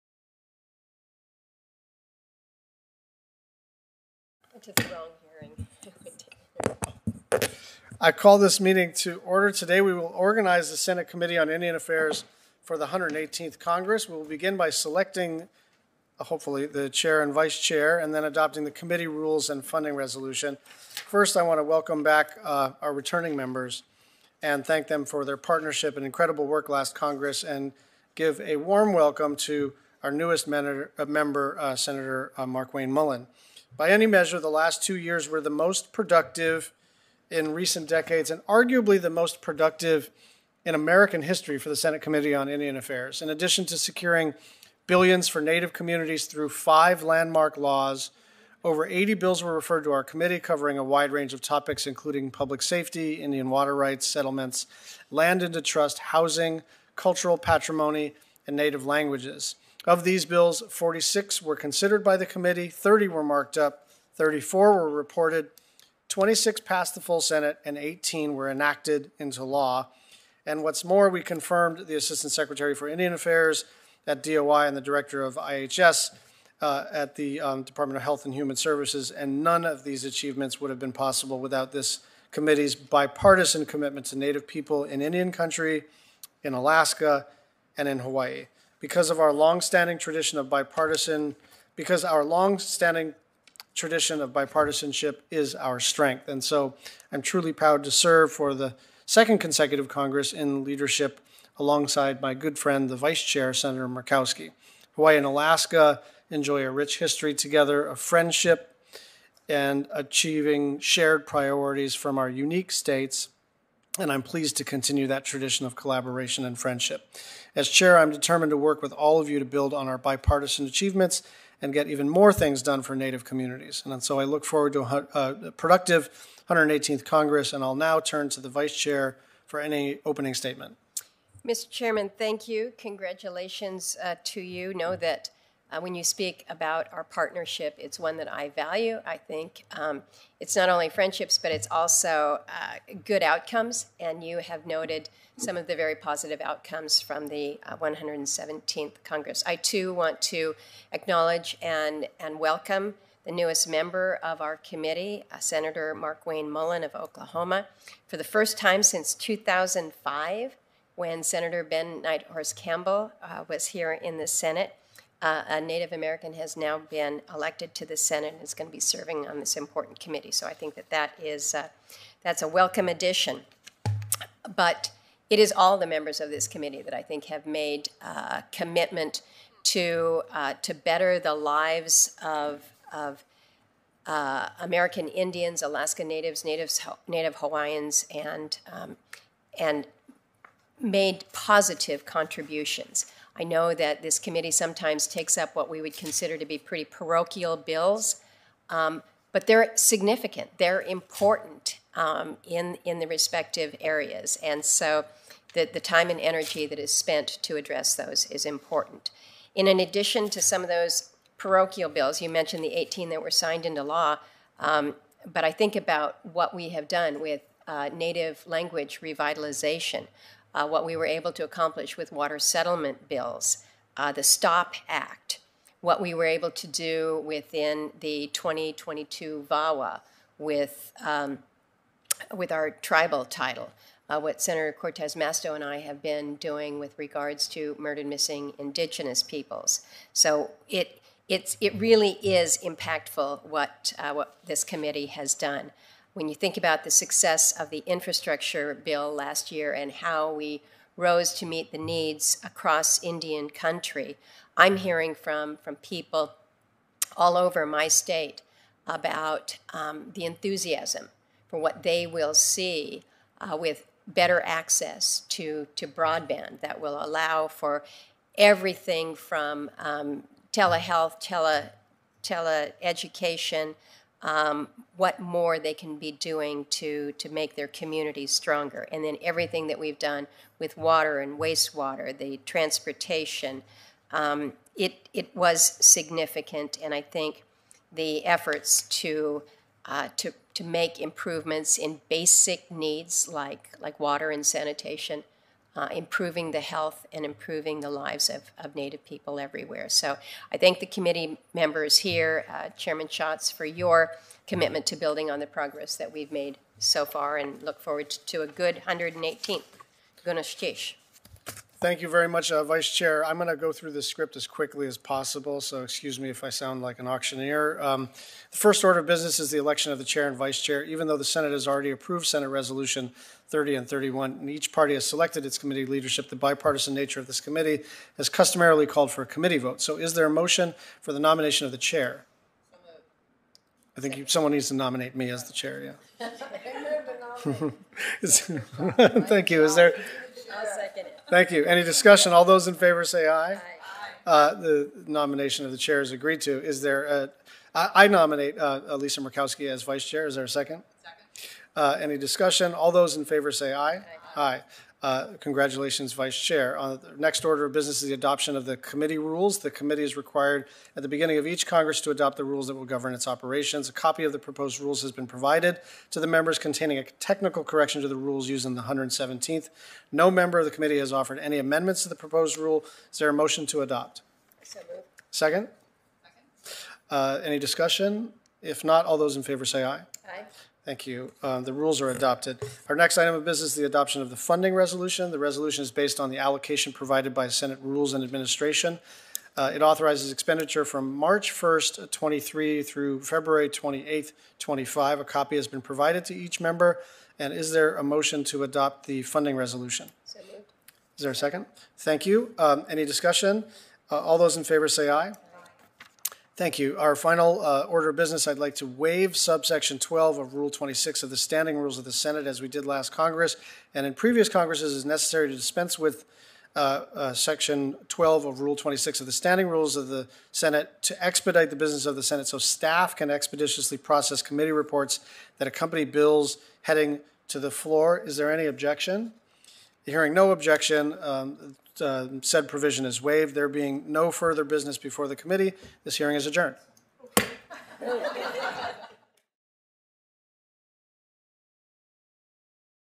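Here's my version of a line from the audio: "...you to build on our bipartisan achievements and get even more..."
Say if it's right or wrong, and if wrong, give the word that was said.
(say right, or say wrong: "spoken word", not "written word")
right.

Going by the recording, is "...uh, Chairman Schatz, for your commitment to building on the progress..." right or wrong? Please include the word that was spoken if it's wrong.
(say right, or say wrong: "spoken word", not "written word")
right.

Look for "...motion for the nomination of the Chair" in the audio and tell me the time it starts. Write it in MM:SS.
05:30.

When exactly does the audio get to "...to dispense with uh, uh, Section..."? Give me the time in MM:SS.
06:55.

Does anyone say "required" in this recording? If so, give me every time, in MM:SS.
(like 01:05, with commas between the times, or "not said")
06:00.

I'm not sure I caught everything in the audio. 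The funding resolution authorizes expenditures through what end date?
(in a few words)
February 28, 2025.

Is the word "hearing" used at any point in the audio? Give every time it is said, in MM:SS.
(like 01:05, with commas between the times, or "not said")
00:05, 04:14, 07:10, 07:16.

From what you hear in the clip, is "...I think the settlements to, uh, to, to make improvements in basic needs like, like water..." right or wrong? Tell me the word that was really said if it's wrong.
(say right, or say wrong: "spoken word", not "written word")
wrong: "efforts", not "settlements".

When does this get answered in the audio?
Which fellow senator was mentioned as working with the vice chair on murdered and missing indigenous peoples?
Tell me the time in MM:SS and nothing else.
03:54.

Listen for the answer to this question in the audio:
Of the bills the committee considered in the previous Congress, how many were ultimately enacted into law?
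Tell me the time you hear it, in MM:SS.
01:07.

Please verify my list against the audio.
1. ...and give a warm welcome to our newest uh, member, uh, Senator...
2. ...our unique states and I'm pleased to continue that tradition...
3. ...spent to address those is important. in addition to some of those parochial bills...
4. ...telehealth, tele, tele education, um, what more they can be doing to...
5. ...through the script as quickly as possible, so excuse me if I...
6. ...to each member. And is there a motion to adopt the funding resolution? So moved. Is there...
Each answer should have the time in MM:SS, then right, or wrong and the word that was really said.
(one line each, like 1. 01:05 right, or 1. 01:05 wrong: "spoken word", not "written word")
1. 00:27 right
2. 01:52 right
3. 03:26 right
4. 04:30 right
5. 05:13 right
6. 06:36 right.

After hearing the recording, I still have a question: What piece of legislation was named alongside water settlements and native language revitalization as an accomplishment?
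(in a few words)
STOP Act.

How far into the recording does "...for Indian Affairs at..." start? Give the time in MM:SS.
01:12.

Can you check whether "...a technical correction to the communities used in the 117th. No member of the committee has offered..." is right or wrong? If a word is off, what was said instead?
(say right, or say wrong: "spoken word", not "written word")
wrong: "rules", not "communities".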